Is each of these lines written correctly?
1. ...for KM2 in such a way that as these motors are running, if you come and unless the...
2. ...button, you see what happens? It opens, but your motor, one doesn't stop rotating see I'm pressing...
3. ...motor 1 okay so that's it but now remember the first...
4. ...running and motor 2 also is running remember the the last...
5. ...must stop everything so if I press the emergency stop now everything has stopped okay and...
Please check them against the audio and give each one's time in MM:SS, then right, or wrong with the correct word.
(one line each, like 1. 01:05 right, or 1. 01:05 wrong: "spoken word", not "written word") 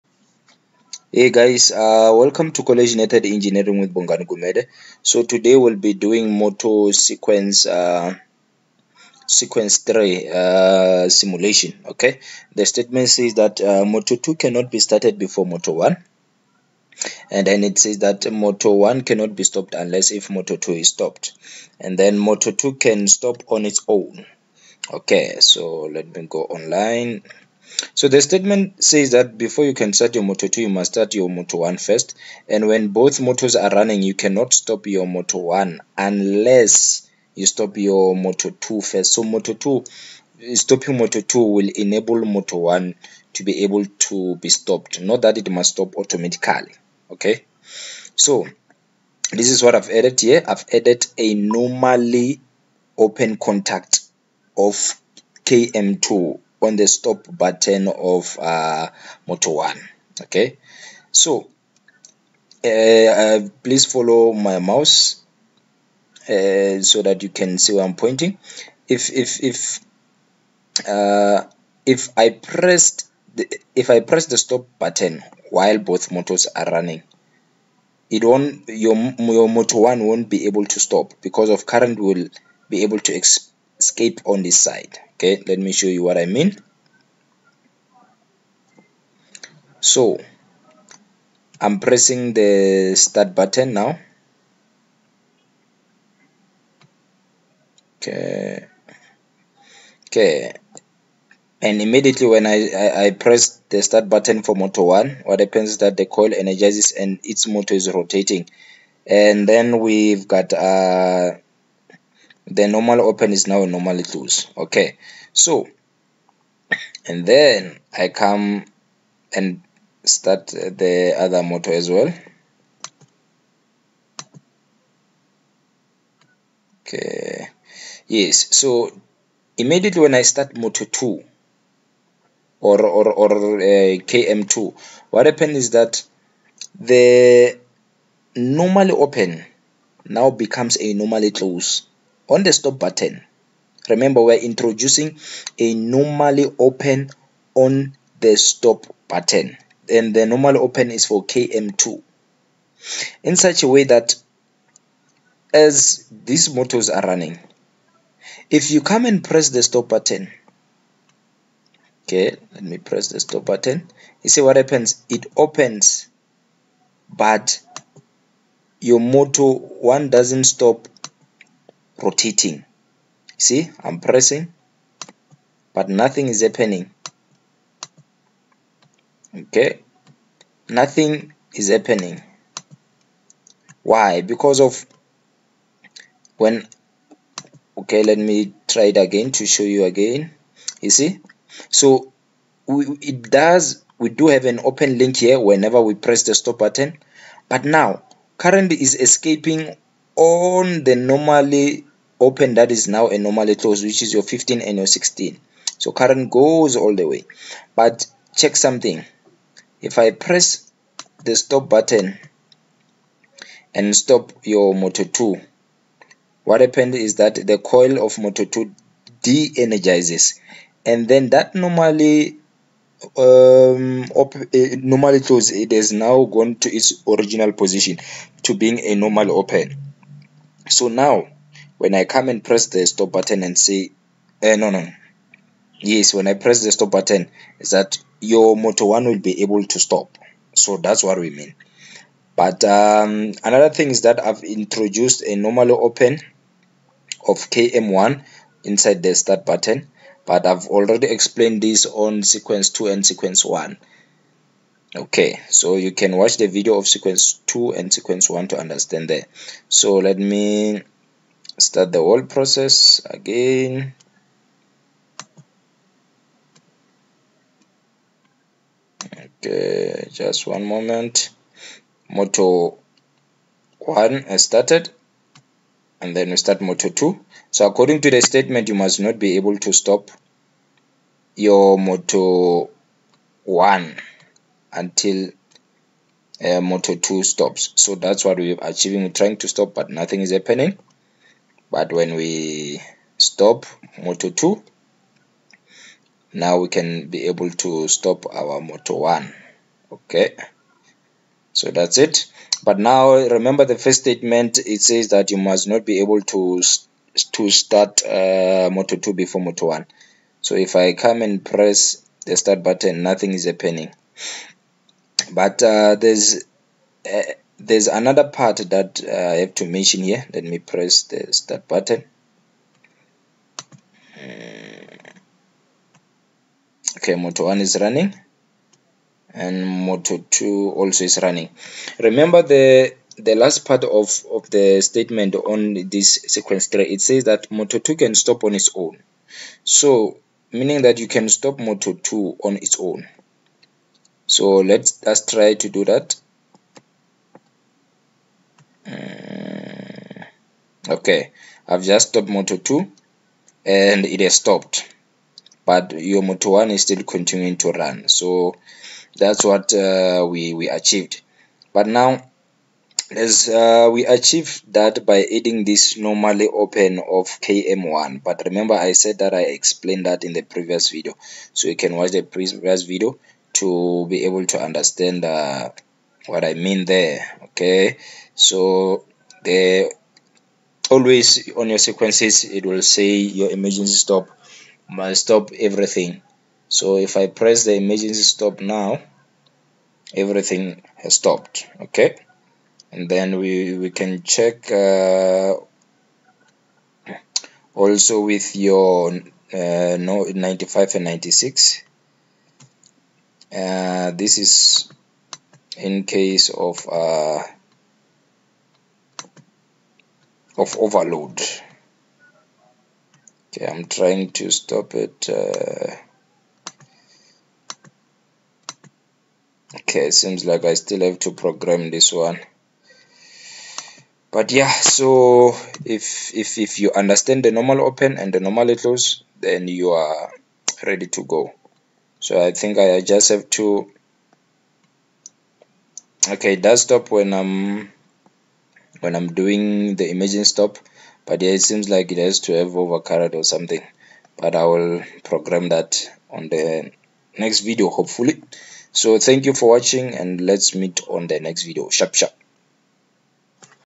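1. 02:31 wrong: "press", not "unless"
2. 02:43 right
3. 04:58 right
4. 05:27 right
5. 06:24 right.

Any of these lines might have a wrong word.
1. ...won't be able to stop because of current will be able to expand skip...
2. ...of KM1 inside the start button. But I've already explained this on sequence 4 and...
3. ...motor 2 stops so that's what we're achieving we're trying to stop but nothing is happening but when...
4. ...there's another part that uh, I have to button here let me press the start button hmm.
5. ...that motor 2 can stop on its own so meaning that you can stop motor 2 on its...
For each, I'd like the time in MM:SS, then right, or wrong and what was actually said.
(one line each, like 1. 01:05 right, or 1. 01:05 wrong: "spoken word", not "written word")
1. 01:20 right
2. 04:07 wrong: "2", not "4"
3. 04:46 right
4. 05:17 wrong: "mention", not "button"
5. 05:37 right.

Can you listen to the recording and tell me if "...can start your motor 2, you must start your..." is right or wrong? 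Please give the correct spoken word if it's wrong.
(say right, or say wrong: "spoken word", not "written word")
right.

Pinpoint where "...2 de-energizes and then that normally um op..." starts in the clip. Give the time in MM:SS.
03:38.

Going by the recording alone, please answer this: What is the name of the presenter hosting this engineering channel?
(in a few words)
Bongan Gumede.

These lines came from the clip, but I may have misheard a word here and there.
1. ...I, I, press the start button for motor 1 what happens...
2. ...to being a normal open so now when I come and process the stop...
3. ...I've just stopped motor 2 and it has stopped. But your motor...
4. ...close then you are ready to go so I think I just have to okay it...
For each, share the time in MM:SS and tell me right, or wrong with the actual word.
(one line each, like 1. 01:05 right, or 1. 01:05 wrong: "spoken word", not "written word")
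1. 01:42 right
2. 03:48 wrong: "press", not "process"
3. 05:51 right
4. 07:08 right.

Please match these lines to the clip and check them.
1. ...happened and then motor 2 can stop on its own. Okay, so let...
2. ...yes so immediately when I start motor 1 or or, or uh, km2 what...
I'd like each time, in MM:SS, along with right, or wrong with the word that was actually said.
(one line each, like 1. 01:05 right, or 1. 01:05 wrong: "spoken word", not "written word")
1. 00:20 wrong: "stopped", not "happened"
2. 02:08 wrong: "2", not "1".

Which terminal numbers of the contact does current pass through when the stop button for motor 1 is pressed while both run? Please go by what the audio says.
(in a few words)
15 and 16.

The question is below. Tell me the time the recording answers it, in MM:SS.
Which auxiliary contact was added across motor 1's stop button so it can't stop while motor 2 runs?
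00:51.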